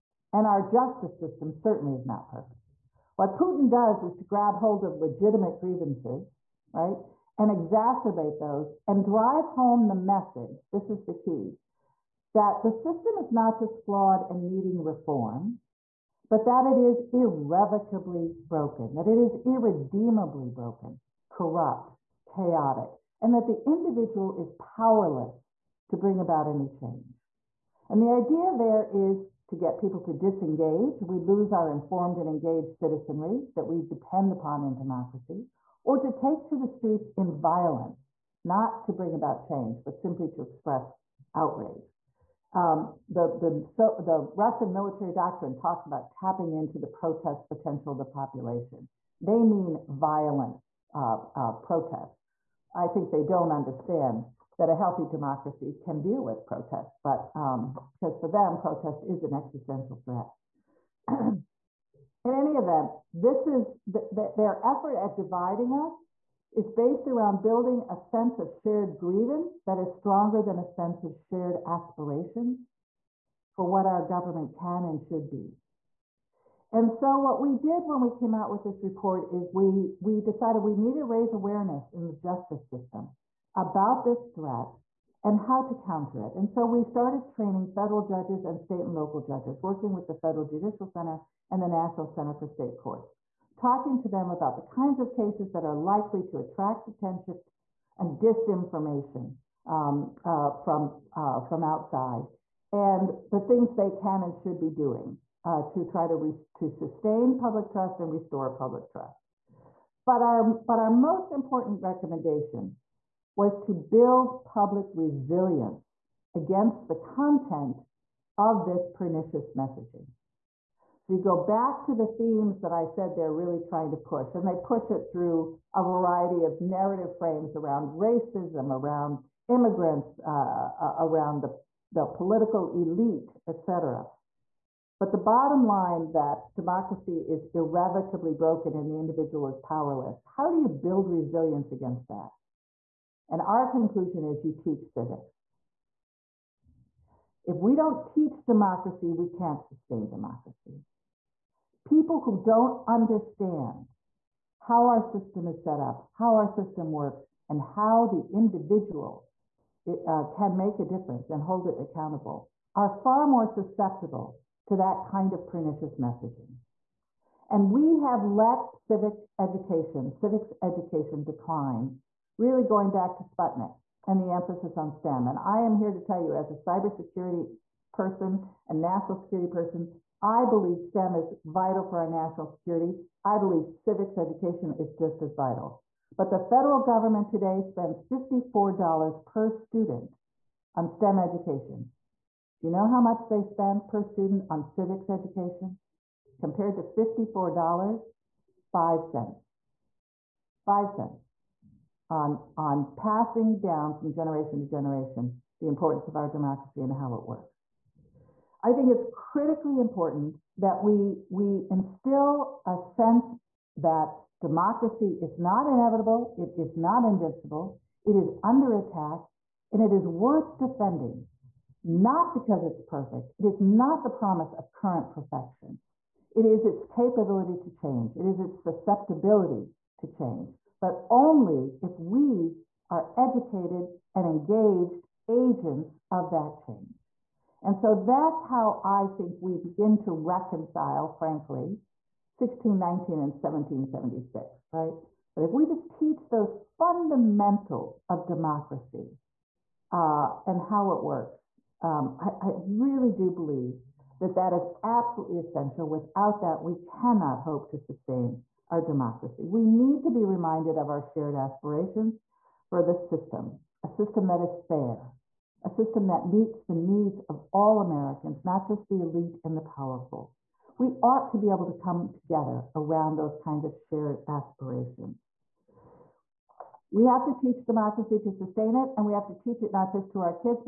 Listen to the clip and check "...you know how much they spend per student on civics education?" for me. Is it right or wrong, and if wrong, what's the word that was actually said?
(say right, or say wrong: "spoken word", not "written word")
right.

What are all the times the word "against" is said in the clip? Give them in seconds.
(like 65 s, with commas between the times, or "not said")
116 s, 141 s.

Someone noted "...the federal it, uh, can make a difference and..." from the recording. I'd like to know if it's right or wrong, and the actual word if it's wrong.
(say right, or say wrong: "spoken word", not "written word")
wrong: "individual", not "federal".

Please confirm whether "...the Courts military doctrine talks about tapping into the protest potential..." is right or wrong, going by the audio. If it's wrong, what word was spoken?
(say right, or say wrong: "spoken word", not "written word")
wrong: "Russian", not "Courts".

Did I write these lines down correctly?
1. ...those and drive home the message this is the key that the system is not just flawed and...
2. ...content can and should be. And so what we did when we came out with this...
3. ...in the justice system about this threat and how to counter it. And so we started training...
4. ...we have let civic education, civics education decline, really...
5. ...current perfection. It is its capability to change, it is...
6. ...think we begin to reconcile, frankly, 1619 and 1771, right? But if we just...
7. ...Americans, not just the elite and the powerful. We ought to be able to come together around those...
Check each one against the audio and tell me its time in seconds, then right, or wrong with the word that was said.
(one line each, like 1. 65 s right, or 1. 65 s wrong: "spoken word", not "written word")
1. 8 s right
2. 74 s wrong: "government", not "content"
3. 81 s right
4. 167 s right
5. 224 s right
6. 239 s wrong: "1776", not "1771"
7. 267 s right.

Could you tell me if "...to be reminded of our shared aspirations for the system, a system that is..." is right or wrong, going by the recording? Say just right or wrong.
right.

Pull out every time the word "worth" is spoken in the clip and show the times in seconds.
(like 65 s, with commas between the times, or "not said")
220 s.